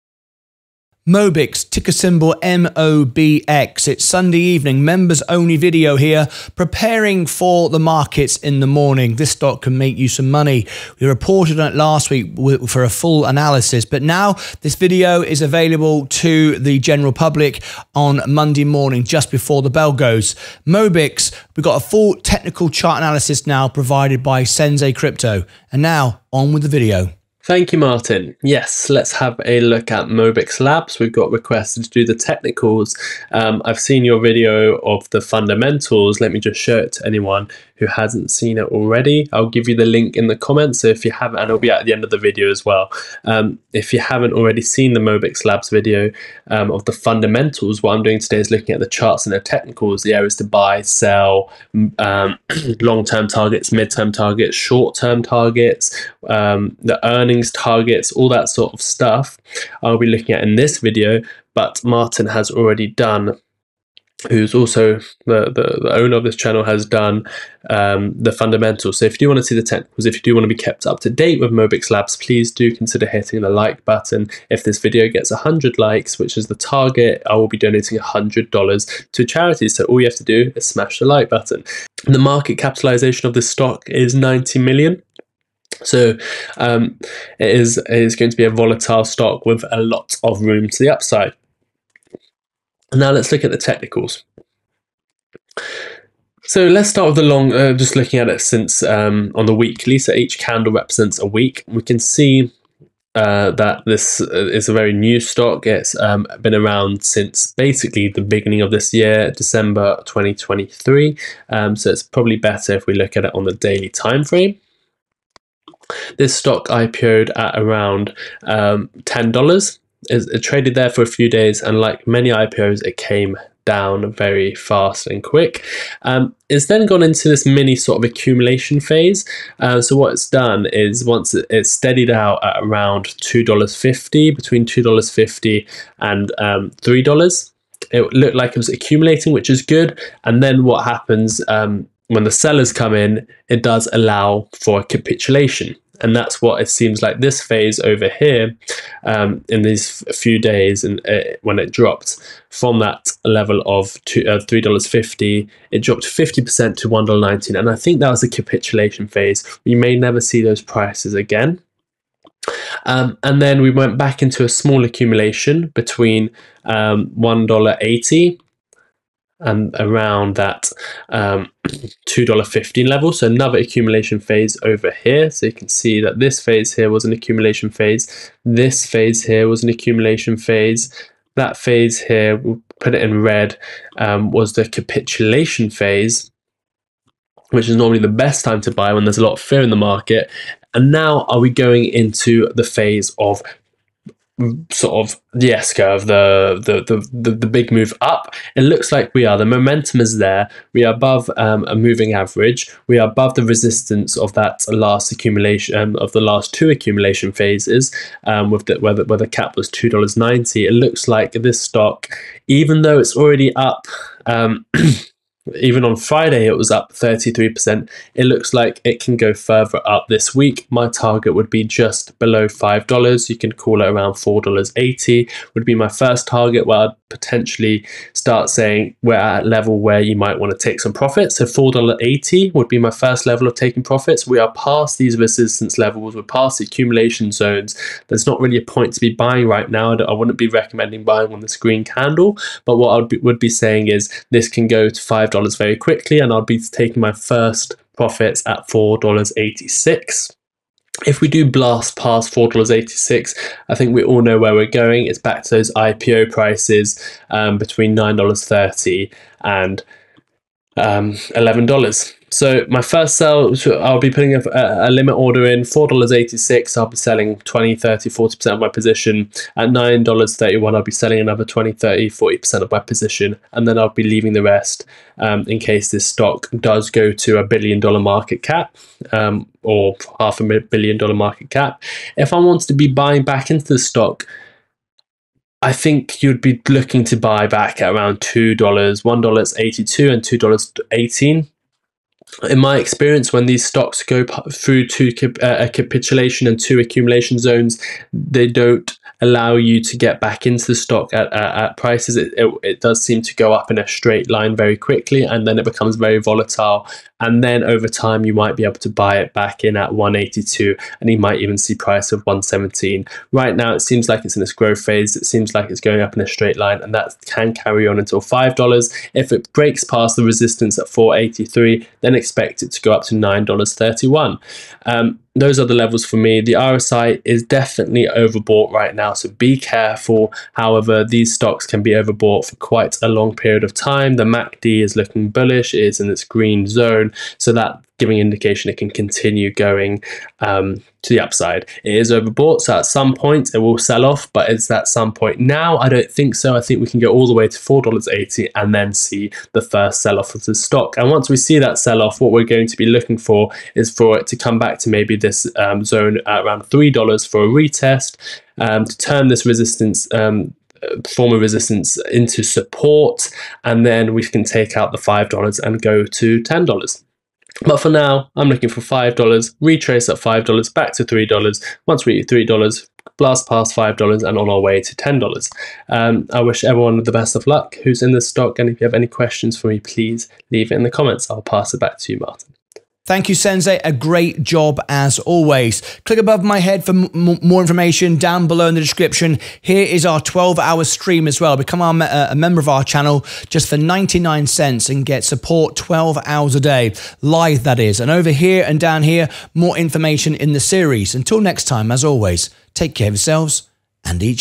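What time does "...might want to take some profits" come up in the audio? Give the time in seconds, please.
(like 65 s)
230 s.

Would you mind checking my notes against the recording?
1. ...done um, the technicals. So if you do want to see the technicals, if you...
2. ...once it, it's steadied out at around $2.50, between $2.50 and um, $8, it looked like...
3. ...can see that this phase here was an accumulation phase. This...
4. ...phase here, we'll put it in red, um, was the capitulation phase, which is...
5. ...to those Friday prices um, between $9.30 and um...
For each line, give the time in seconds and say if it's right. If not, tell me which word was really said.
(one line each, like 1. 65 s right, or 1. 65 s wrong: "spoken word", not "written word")
1. 66 s wrong: "fundamentals", not "technicals"
2. 131 s wrong: "3", not "8"
3. 175 s right
4. 181 s right
5. 255 s wrong: "IPO", not "Friday".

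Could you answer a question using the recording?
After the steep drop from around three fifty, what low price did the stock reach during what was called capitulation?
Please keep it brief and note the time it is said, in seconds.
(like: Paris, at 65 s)
$1.19, at 156 s.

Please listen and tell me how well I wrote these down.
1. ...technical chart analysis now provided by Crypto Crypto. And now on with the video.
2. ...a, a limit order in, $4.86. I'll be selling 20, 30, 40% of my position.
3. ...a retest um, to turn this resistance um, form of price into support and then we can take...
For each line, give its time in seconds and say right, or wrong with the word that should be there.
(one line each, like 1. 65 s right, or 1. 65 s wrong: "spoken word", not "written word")
1. 22 s wrong: "Sensei", not "Crypto"
2. 264 s right
3. 357 s wrong: "resistance", not "price".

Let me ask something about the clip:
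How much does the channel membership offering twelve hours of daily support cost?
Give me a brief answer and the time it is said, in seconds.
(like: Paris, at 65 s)
99 cents, at 393 s.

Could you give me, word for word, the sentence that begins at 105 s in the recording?
It's um, been around since basically the beginning of this year, December 2023.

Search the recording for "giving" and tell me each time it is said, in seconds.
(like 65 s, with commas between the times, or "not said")
337 s.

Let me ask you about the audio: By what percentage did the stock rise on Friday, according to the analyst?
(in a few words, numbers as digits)
33%.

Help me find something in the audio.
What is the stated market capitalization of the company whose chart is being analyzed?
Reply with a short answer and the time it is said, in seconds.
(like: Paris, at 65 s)
90 million, at 84 s.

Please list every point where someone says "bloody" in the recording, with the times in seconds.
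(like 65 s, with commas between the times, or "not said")
not said.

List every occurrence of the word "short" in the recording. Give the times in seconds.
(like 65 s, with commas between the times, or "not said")
54 s.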